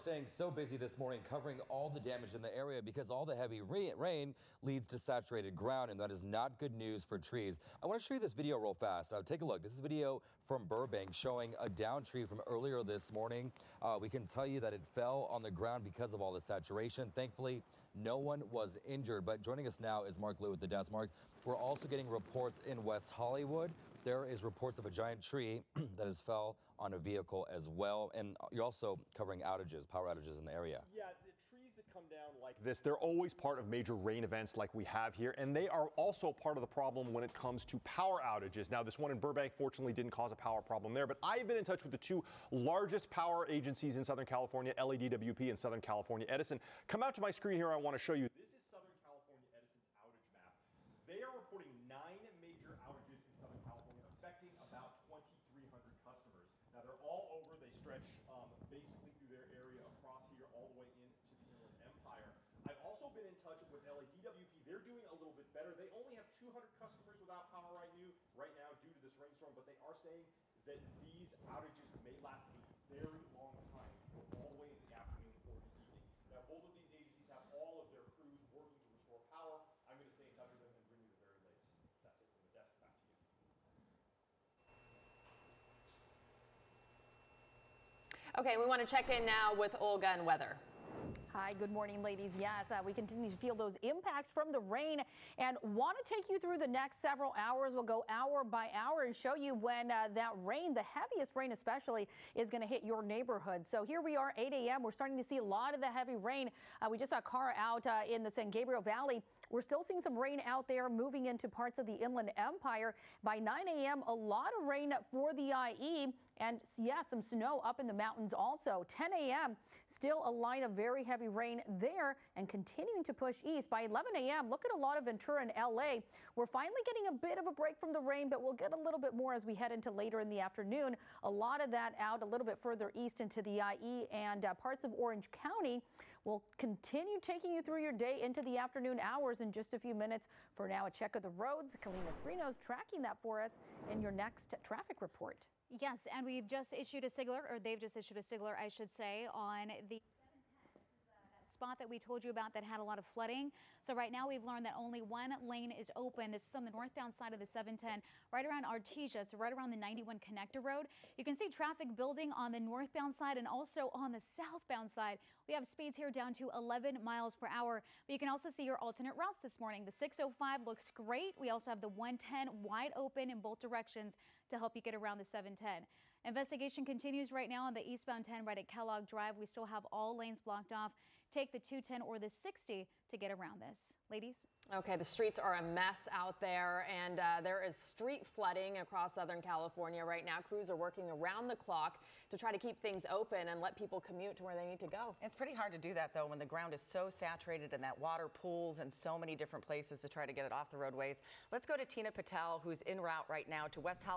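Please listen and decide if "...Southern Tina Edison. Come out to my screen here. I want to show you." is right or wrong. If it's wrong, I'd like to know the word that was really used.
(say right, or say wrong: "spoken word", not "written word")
wrong: "California", not "Tina".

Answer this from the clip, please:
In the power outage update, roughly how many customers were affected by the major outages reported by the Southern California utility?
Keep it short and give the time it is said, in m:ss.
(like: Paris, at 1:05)
2,300, at 0:55.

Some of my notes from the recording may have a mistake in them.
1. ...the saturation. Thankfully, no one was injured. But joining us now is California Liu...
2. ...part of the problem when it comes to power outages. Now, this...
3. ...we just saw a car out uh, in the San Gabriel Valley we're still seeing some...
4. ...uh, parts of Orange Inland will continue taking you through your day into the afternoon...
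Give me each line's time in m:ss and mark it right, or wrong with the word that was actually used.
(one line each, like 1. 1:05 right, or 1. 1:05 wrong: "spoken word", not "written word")
1. 0:16 wrong: "Mark", not "California"
2. 0:36 right
3. 1:46 right
4. 2:14 wrong: "County", not "Inland".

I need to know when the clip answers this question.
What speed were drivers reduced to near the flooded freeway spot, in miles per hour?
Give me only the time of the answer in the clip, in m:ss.
2:46.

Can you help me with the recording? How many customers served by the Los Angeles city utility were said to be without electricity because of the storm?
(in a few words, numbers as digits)
200.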